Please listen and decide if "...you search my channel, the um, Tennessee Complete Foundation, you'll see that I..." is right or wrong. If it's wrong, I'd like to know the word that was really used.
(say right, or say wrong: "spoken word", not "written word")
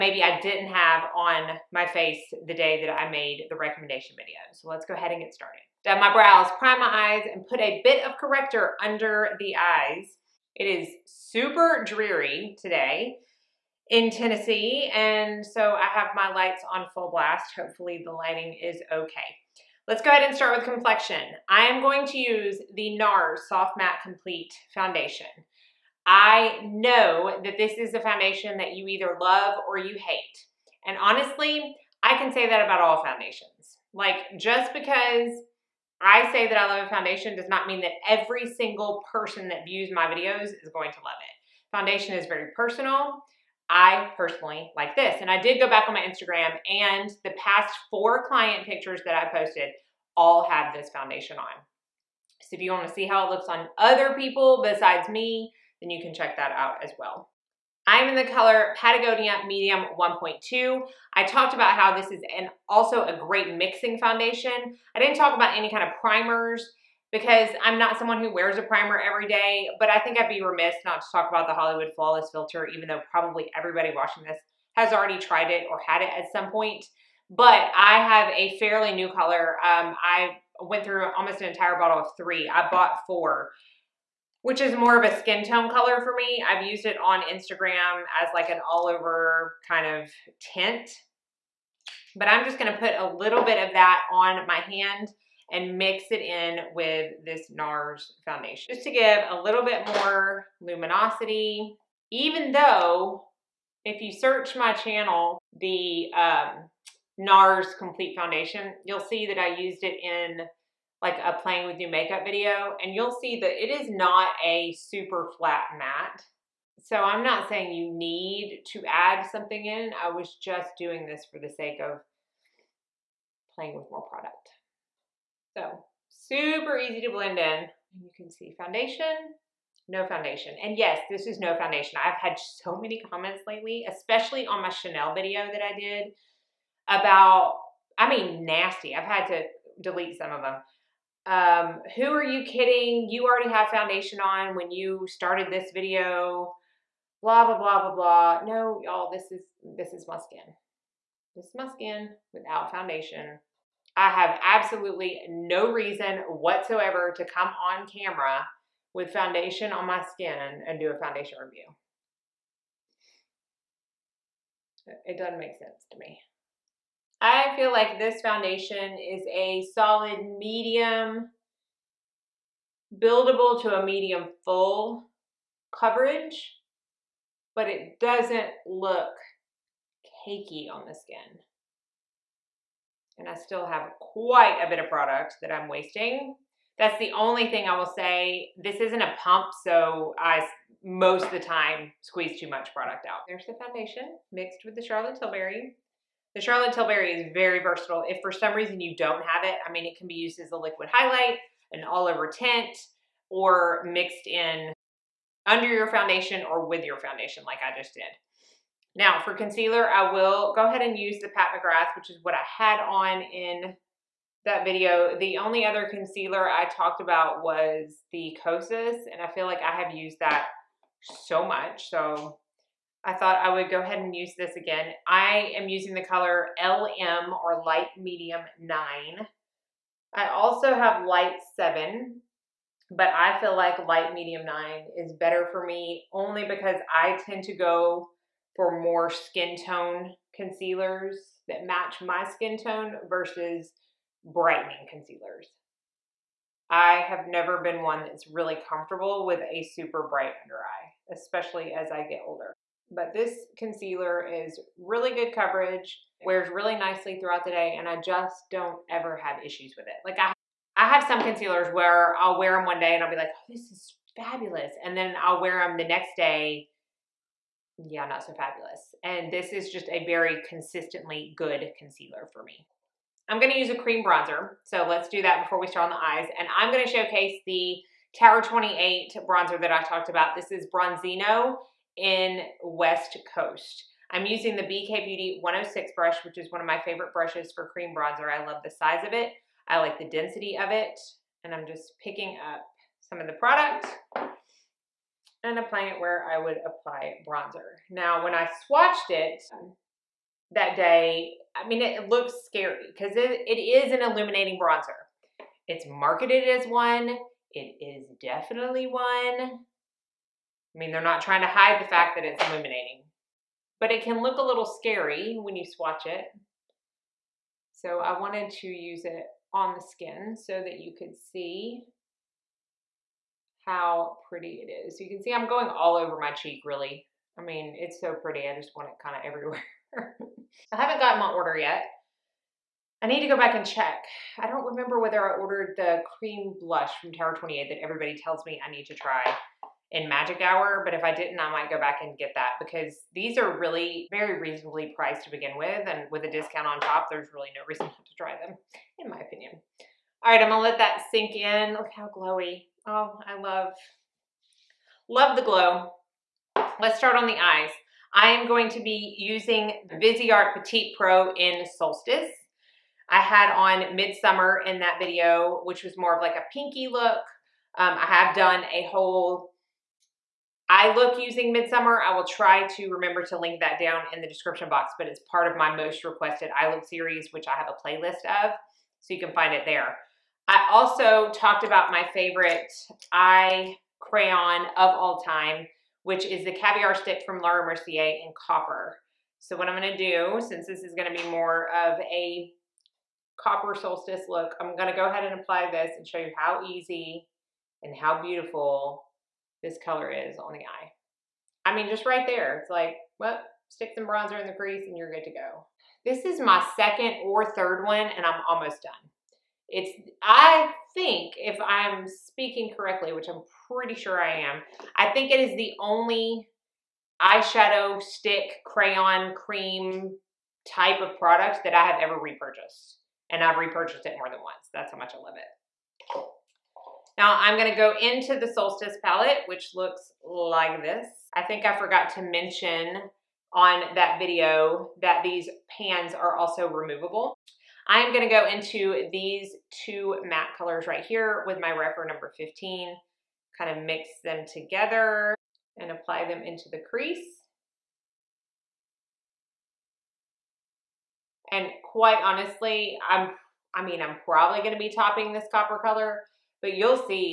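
wrong: "NARS", not "Tennessee".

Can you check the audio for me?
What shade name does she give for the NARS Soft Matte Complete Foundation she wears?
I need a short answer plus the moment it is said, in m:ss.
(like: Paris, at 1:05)
Patagonia Medium 1.2, at 0:58.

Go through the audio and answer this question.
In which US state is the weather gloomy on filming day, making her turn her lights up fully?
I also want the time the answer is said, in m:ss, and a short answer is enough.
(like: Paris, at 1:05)
Tennessee, at 0:14.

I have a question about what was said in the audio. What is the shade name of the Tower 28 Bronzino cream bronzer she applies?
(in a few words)
West Coast.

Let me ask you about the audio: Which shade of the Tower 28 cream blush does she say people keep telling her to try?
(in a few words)
Magic Hour.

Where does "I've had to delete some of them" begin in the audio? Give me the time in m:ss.
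2:18.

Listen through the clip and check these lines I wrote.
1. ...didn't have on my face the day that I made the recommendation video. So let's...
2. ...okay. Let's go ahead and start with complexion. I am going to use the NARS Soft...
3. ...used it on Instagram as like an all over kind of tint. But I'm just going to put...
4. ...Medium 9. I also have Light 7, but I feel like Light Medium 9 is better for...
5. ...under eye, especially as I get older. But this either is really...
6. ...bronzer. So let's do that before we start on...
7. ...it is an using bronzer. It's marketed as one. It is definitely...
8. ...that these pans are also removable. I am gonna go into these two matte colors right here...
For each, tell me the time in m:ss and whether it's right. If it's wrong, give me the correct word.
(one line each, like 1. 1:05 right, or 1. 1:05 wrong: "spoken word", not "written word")
1. 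0:00 right
2. 0:18 right
3. 1:26 right
4. 3:47 right
5. 4:10 wrong: "concealer", not "either"
6. 4:34 right
7. 5:03 wrong: "illuminating", not "using"
8. 7:15 right.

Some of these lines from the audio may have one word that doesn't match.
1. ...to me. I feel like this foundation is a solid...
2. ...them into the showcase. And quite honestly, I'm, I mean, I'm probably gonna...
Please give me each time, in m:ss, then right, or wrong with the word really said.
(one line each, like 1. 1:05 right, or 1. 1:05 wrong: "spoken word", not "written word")
1. 2:45 right
2. 7:26 wrong: "crease", not "showcase".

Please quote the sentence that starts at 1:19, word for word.
Um, I went through almost an entire bottle of three.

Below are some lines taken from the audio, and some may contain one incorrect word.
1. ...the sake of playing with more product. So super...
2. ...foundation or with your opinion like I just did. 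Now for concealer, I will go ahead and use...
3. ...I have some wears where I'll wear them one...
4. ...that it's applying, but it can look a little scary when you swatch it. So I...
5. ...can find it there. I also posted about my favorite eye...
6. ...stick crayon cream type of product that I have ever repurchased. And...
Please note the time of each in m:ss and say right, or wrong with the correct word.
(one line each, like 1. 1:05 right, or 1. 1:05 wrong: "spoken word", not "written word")
1. 2:01 right
2. 3:25 wrong: "foundation", not "opinion"
3. 4:20 wrong: "concealers", not "wears"
4. 5:12 wrong: "illuminating", not "applying"
5. 6:19 wrong: "talked", not "posted"
6. 6:58 right.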